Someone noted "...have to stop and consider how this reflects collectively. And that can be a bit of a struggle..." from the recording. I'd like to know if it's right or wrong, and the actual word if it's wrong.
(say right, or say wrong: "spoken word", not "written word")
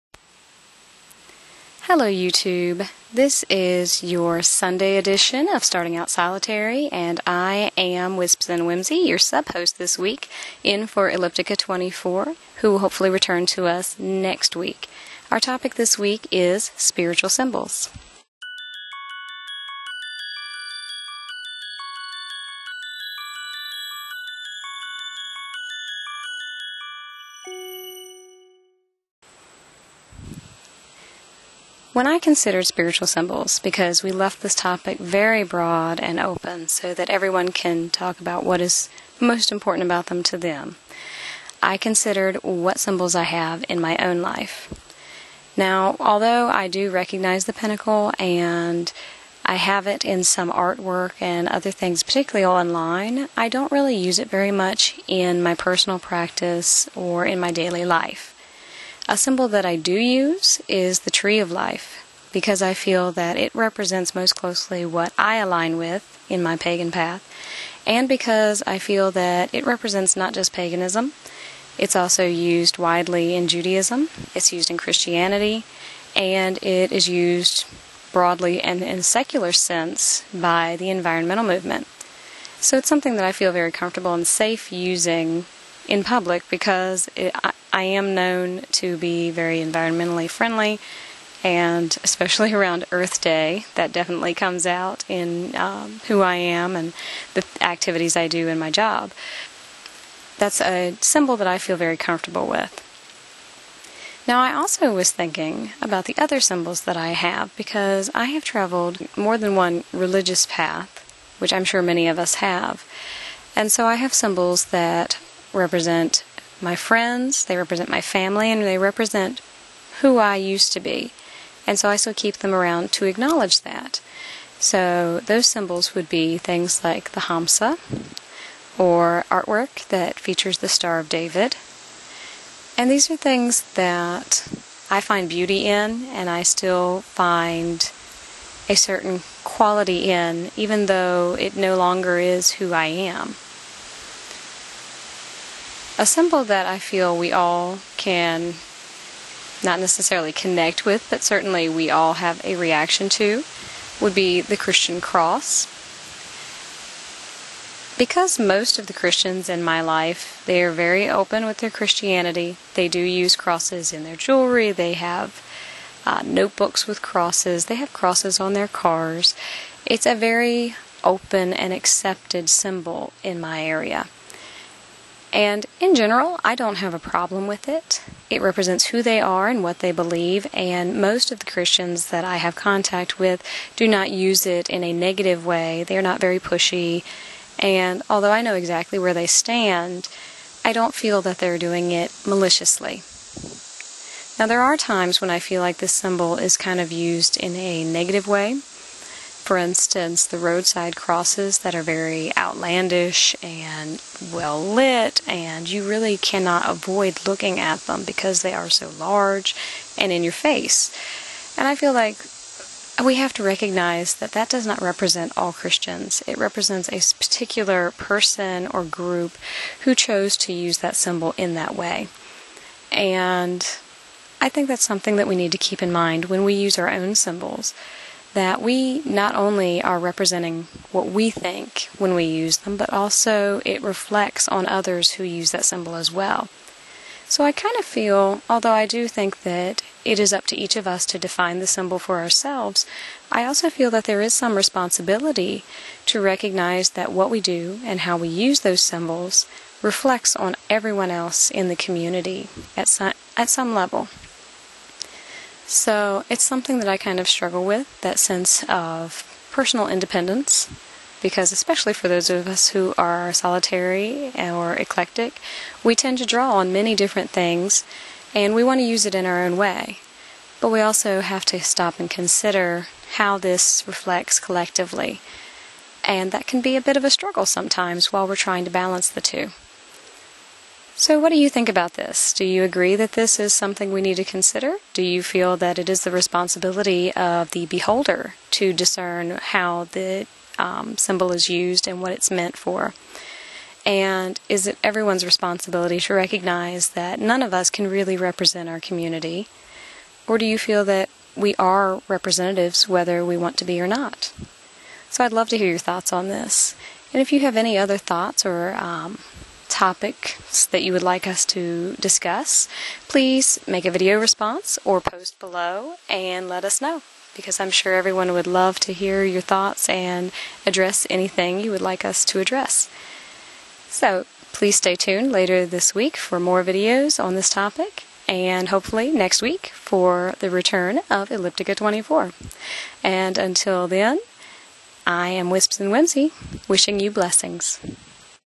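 right.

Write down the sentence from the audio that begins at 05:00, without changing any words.
Or do you feel that we are representatives whether we want to be or not?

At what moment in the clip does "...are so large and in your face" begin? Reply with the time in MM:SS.
03:28.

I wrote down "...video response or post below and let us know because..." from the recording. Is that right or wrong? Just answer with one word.
right.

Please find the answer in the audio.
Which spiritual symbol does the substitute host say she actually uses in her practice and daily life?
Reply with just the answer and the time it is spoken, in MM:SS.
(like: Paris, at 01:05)
Tree of life, at 01:01.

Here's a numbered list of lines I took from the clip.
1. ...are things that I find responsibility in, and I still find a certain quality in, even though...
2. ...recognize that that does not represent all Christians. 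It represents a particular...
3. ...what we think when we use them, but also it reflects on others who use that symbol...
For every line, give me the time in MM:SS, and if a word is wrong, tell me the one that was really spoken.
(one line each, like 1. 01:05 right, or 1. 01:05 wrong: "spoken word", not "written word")
1. 02:13 wrong: "beauty", not "responsibility"
2. 03:33 right
3. 03:50 right.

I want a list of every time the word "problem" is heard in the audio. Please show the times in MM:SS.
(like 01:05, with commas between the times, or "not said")
02:56.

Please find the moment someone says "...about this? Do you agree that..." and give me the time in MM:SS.
04:41.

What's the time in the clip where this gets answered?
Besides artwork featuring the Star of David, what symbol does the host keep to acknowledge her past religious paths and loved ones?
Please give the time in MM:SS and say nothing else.
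02:07.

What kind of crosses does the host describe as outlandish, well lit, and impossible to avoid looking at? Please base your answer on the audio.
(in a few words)
Roadside crosses.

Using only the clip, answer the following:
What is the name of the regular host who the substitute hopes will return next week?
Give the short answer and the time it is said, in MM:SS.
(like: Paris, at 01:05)
Eliptica24, at 00:11.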